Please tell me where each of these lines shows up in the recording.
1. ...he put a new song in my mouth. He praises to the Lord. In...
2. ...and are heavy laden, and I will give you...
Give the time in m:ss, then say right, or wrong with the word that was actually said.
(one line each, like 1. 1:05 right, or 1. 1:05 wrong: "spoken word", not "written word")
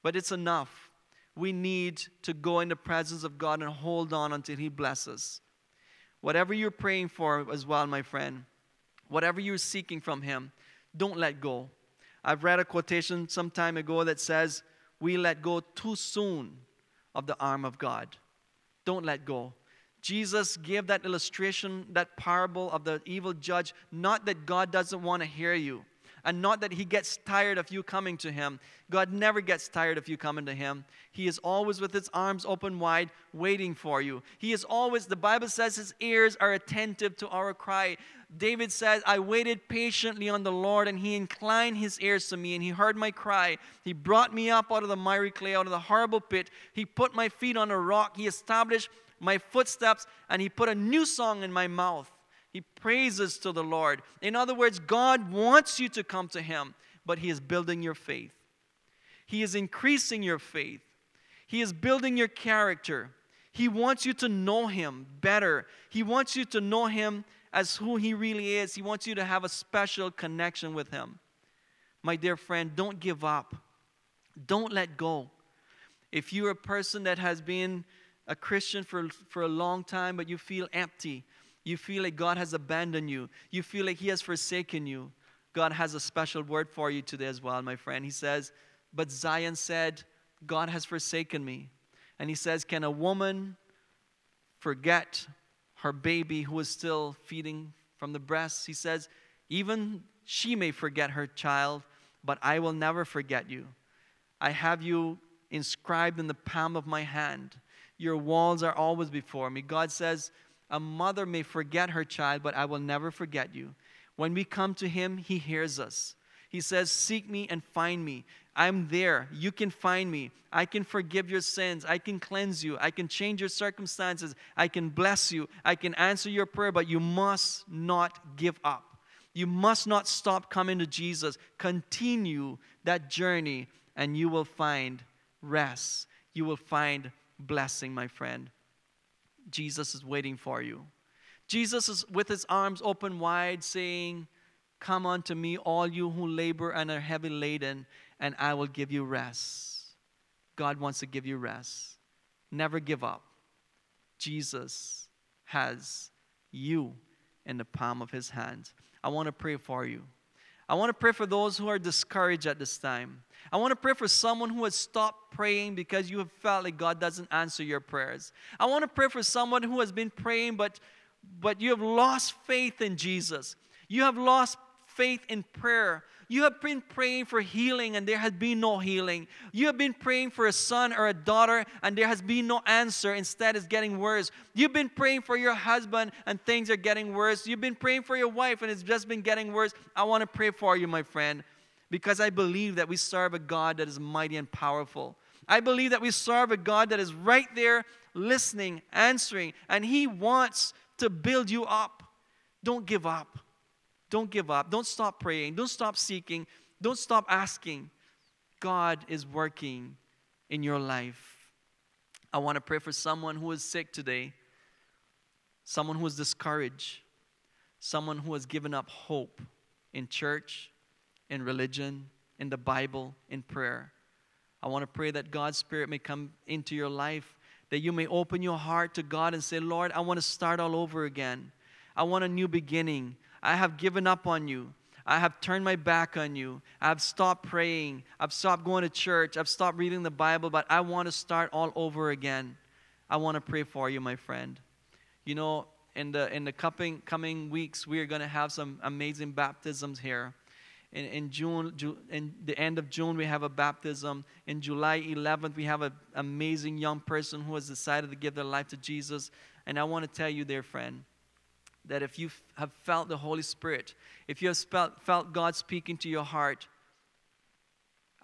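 1. 0:50 right
2. 2:26 right.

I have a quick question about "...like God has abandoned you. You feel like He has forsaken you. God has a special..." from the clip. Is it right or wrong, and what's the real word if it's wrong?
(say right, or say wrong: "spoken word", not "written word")
right.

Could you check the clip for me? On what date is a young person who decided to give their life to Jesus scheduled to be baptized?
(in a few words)
July 11.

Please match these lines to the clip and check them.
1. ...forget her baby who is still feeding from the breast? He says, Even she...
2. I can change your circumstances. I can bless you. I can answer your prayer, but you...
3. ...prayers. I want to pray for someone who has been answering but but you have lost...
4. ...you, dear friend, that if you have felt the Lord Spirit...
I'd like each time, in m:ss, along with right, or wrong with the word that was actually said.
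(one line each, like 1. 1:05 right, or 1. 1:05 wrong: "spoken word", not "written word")
1. 1:34 right
2. 2:02 right
3. 2:47 wrong: "praying", not "answering"
4. 4:20 wrong: "Holy", not "Lord".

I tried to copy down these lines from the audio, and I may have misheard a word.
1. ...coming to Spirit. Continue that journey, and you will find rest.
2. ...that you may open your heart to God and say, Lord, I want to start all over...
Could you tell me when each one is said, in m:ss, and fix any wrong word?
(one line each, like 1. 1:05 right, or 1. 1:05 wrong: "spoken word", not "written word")
1. 2:10 wrong: "Jesus", not "Spirit"
2. 3:47 right.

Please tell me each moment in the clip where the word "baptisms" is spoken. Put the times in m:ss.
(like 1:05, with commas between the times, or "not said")
4:09, 4:13.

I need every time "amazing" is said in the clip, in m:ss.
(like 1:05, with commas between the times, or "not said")
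4:08, 4:16.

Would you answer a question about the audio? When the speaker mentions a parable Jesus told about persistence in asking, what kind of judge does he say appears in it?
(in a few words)
evil judge.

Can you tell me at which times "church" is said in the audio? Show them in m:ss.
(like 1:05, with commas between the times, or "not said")
3:40, 3:58.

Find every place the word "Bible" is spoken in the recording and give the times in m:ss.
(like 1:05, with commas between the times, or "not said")
0:35, 3:42, 4:00.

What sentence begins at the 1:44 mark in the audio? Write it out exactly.
I have you inscribed in the palm of my hand.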